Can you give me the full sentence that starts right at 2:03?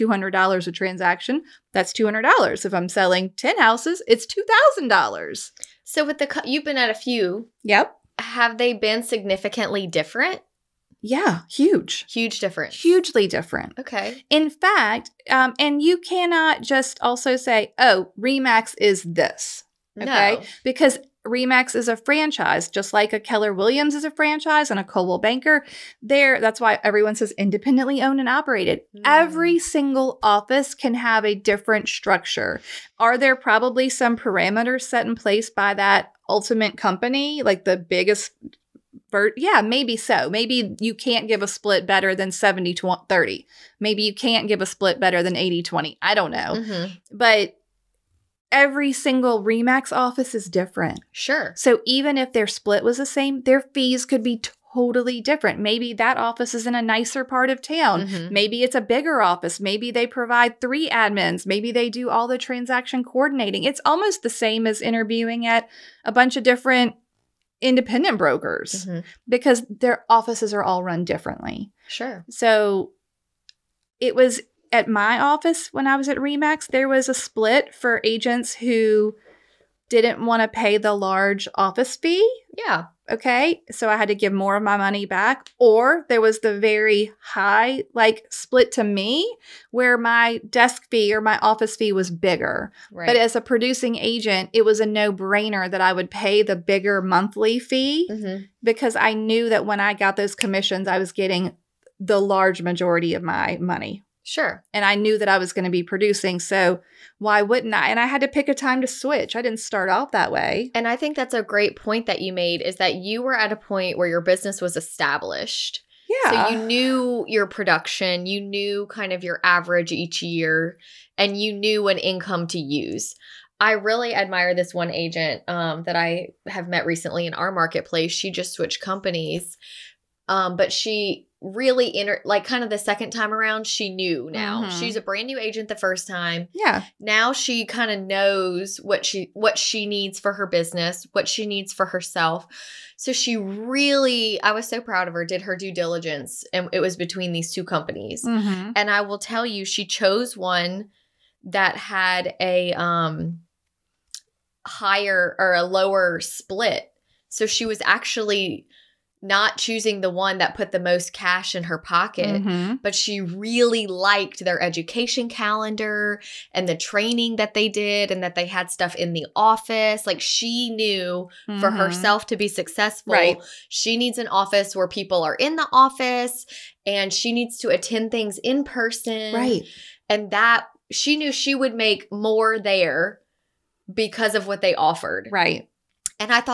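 I really admire this one agent um, that I have met recently in our marketplace.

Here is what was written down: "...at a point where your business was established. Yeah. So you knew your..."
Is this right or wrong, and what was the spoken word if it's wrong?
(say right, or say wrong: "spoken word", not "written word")
right.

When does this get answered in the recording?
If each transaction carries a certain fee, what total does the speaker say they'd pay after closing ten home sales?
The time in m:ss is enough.
0:04.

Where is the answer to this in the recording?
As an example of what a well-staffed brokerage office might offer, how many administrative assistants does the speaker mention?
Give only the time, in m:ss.
1:00.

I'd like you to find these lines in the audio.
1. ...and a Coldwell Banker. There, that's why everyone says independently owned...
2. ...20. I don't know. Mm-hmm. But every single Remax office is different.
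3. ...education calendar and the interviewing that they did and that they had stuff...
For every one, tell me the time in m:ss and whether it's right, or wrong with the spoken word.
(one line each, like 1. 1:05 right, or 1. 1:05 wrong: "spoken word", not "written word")
1. 0:24 right
2. 0:45 right
3. 2:44 wrong: "training", not "interviewing".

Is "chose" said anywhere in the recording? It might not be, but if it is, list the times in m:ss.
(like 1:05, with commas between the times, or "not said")
2:29.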